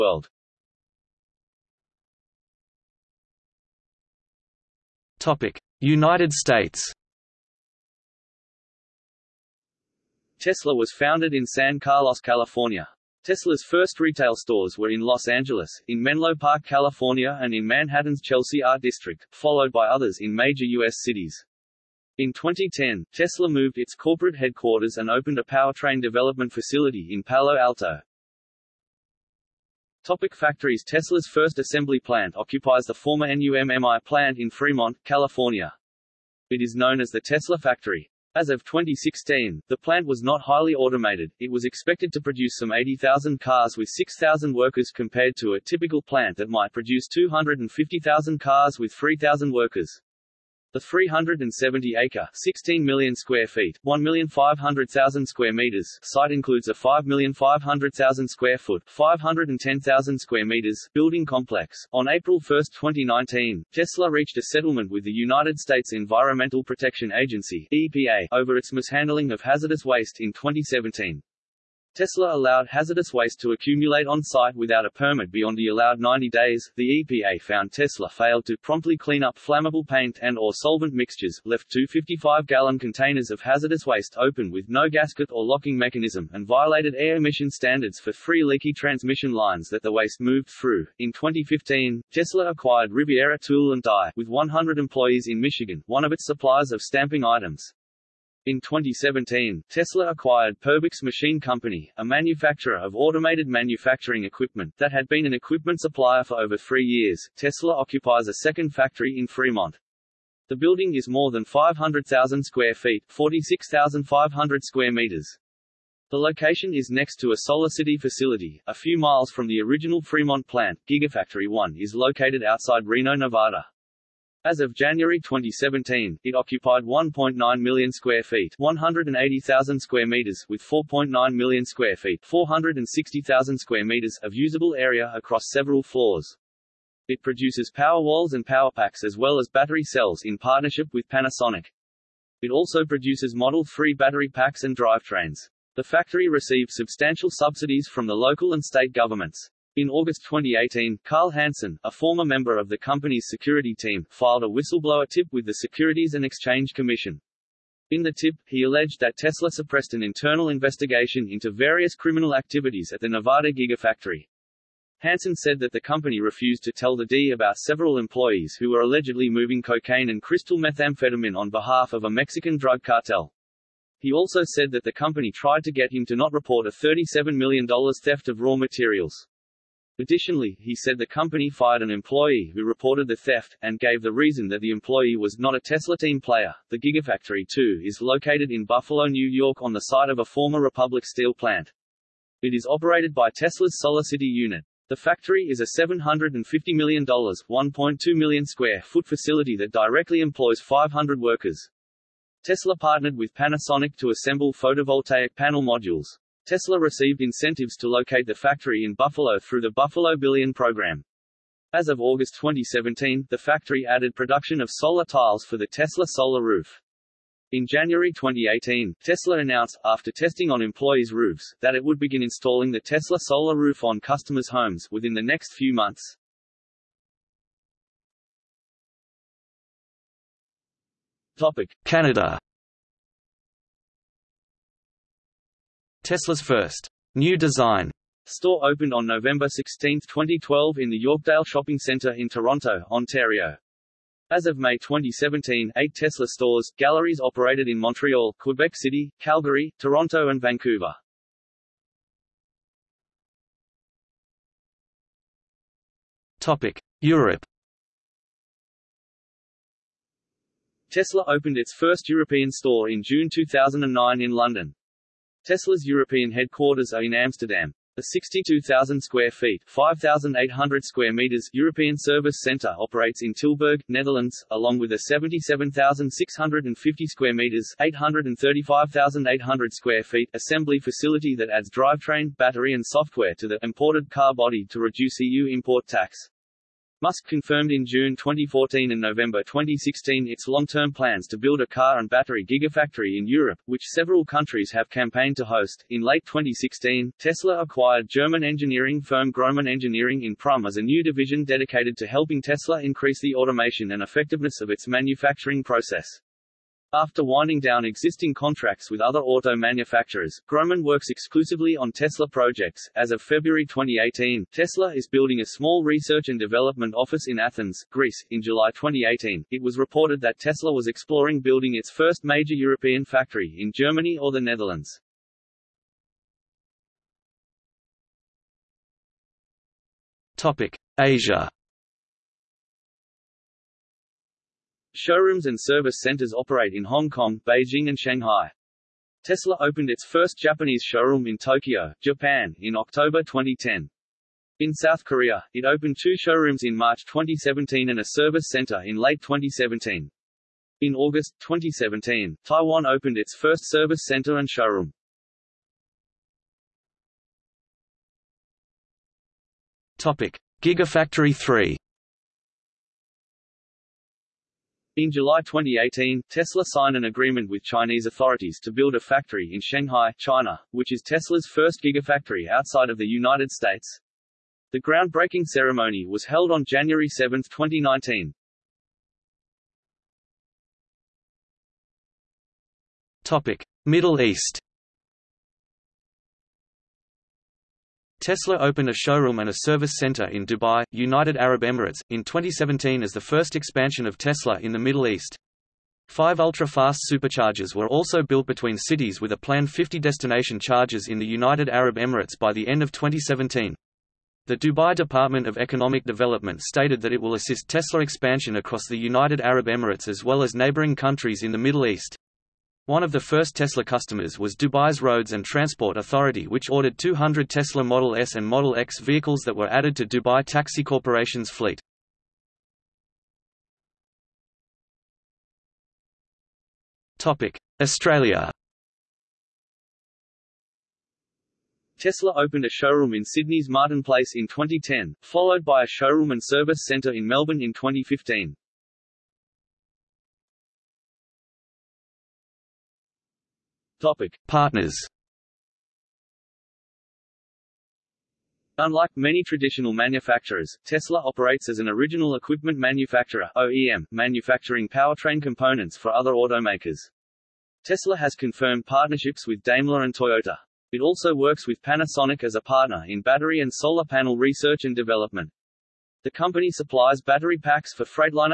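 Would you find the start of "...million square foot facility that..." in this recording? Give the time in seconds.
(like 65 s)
198 s.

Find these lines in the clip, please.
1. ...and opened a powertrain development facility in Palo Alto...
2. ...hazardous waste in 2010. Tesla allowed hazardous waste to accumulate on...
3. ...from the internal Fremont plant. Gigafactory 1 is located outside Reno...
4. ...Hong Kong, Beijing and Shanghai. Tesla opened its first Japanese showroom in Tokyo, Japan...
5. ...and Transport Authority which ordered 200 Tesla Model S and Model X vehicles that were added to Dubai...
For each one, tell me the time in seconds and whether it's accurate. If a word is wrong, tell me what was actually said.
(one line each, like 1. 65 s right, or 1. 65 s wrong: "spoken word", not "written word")
1. 24 s right
2. 69 s wrong: "2017", not "2010"
3. 119 s wrong: "original", not "internal"
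4. 336 s right
5. 415 s right.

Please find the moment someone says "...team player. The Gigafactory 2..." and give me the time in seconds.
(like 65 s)
185 s.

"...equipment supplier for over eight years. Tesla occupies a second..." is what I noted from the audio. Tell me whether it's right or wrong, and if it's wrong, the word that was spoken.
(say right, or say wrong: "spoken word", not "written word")
wrong: "three", not "eight".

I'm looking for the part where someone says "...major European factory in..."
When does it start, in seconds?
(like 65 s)
322 s.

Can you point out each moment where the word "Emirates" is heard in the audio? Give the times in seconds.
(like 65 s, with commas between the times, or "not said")
391 s, 401 s, 409 s.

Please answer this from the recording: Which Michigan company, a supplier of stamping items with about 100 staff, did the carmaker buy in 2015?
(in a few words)
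Riviera Tool and Die.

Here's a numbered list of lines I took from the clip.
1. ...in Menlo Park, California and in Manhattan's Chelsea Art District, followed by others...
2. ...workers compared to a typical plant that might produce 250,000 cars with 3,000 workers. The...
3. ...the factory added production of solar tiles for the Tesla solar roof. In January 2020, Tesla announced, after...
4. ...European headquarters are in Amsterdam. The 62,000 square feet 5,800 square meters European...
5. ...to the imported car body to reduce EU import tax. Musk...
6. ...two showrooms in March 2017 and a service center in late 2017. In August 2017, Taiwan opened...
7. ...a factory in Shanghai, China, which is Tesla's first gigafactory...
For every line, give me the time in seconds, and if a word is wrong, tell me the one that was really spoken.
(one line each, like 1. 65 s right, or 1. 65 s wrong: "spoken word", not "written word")
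1. 15 s right
2. 44 s right
3. 213 s wrong: "2018", not "2020"
4. 265 s right
5. 283 s right
6. 346 s right
7. 368 s right.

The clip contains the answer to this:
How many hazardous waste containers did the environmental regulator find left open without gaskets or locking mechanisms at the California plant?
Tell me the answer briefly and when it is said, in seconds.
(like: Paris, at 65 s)
255, at 81 s.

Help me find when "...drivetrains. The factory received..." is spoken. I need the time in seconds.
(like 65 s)
144 s.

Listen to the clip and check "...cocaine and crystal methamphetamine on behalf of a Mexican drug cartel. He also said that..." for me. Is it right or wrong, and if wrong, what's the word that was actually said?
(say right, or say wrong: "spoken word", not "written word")
right.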